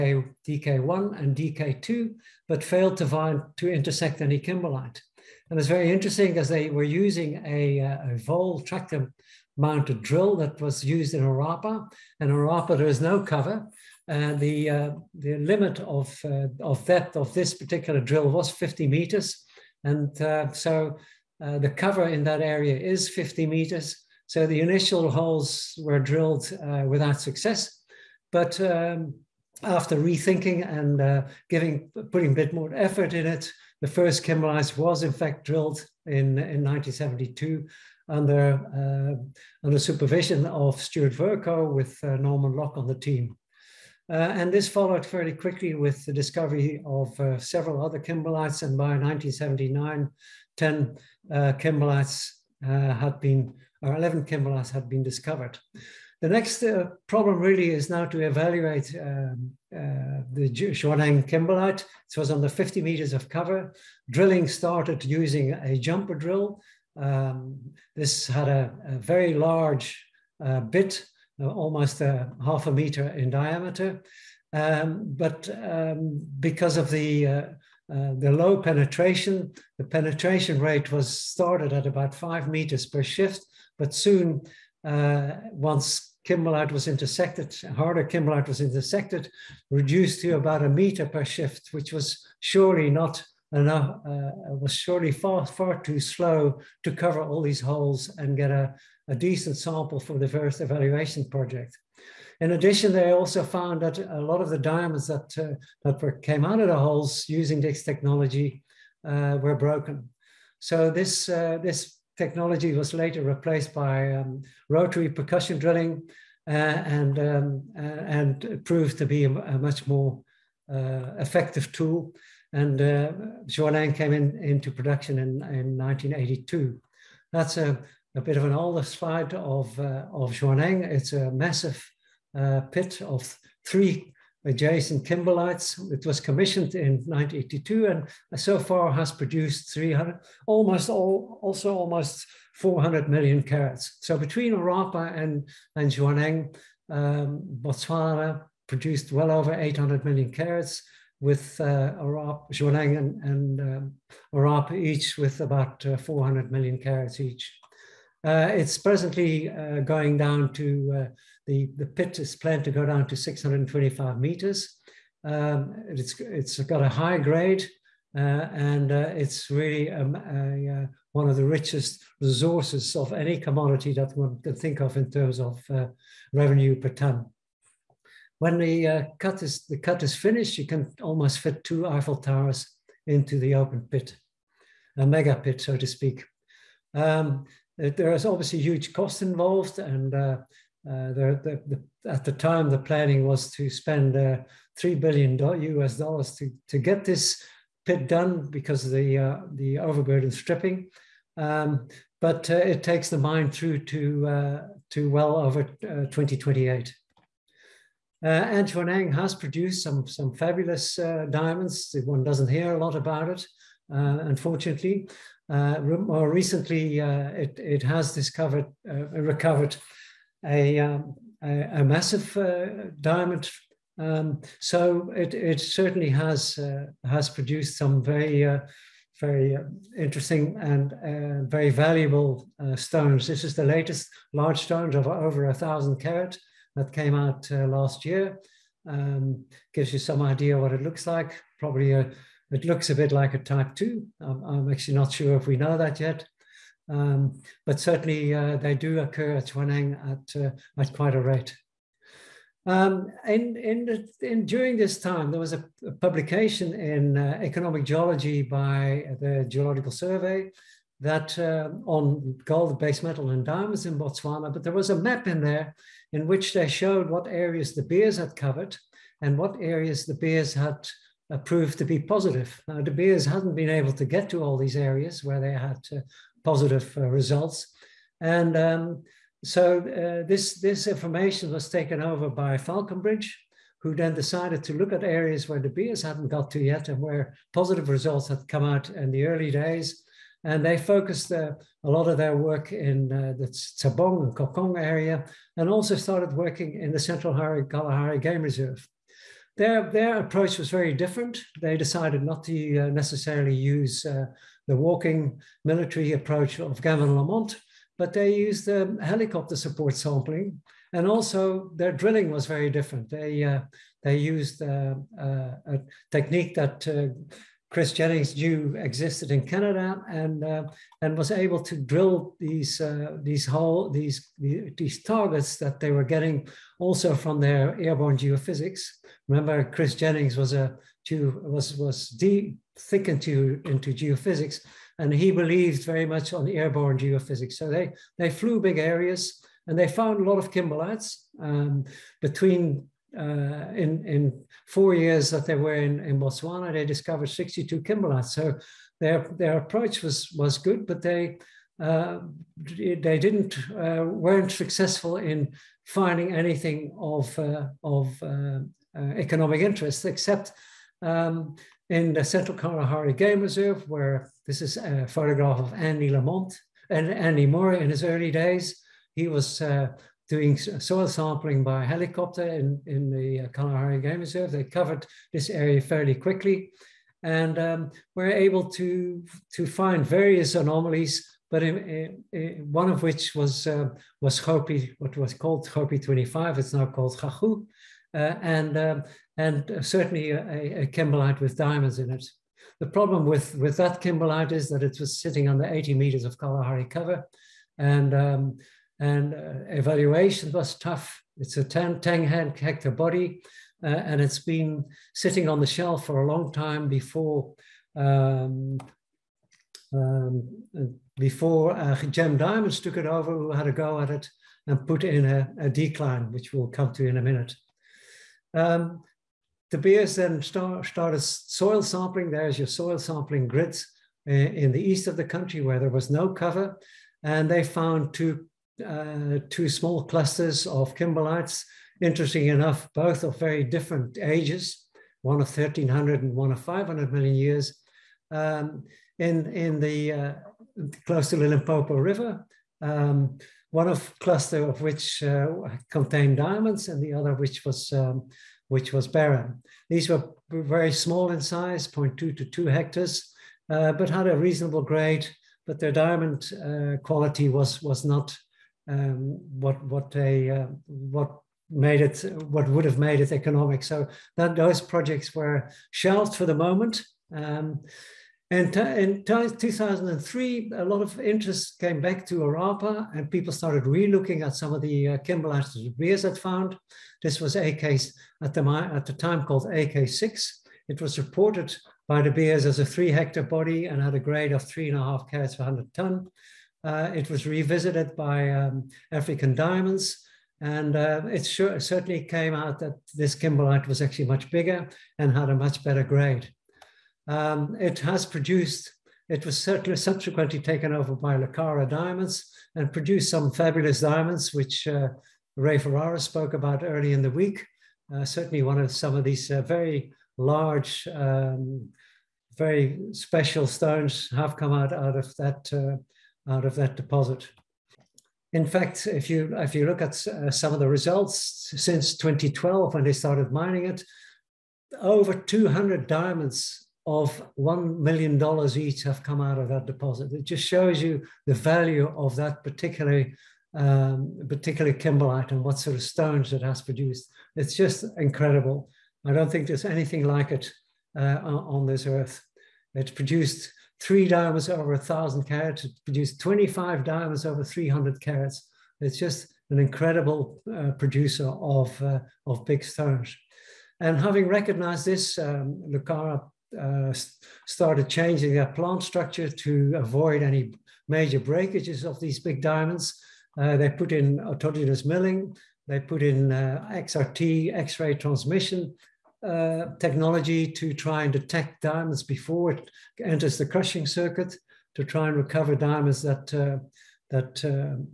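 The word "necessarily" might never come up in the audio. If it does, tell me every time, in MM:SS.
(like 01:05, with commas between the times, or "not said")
05:02.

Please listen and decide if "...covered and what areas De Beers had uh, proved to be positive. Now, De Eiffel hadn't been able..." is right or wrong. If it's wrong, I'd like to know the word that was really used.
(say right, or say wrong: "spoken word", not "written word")
wrong: "Beers", not "Eiffel".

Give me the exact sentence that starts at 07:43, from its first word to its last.
So that those projects were shelved for the moment.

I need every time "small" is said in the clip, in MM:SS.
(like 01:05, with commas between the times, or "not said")
07:09, 07:30.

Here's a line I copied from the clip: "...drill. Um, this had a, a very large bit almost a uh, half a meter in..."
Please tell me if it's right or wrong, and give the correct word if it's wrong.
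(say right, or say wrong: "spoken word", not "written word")
right.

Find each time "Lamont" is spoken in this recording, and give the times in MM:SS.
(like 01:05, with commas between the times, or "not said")
05:07, 06:06.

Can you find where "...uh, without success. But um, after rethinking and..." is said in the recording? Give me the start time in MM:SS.
00:26.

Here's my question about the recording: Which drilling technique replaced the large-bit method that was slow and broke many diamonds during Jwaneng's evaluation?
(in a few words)
rotary percussion drilling.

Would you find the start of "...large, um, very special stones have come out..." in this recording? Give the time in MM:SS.
08:30.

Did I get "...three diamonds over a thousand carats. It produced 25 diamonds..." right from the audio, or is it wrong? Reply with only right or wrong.
right.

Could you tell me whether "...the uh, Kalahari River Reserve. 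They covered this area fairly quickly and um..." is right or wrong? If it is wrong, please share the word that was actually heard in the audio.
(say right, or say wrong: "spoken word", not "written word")
wrong: "Game", not "River".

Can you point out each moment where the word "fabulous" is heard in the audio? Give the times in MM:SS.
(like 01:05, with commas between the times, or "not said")
03:30, 08:23.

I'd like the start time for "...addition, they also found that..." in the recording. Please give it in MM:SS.
01:42.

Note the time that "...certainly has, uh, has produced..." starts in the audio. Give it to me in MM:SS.
03:45.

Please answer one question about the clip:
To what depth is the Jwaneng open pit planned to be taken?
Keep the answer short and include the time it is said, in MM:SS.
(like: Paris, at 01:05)
625 meters, at 02:43.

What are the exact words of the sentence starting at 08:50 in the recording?
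It just shows you the value of that particular, um, particular kimberlite and what sort of stones it has produced.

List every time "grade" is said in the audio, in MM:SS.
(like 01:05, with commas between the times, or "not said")
02:47, 07:34, 08:04, 08:16.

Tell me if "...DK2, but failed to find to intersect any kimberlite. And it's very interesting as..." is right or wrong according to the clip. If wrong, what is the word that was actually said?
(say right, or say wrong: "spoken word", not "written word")
right.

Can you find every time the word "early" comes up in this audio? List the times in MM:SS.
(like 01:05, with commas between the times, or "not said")
04:49, 06:08, 08:26.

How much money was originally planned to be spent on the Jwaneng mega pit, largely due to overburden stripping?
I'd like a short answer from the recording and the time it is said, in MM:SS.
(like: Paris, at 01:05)
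3 billion US dollars, at 03:14.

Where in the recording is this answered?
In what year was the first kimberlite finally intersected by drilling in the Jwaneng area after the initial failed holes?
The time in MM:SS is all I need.
00:36.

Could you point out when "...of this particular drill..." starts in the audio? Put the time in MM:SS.
00:17.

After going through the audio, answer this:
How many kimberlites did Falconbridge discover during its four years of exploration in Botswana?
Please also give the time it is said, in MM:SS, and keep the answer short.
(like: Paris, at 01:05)
62, at 05:47.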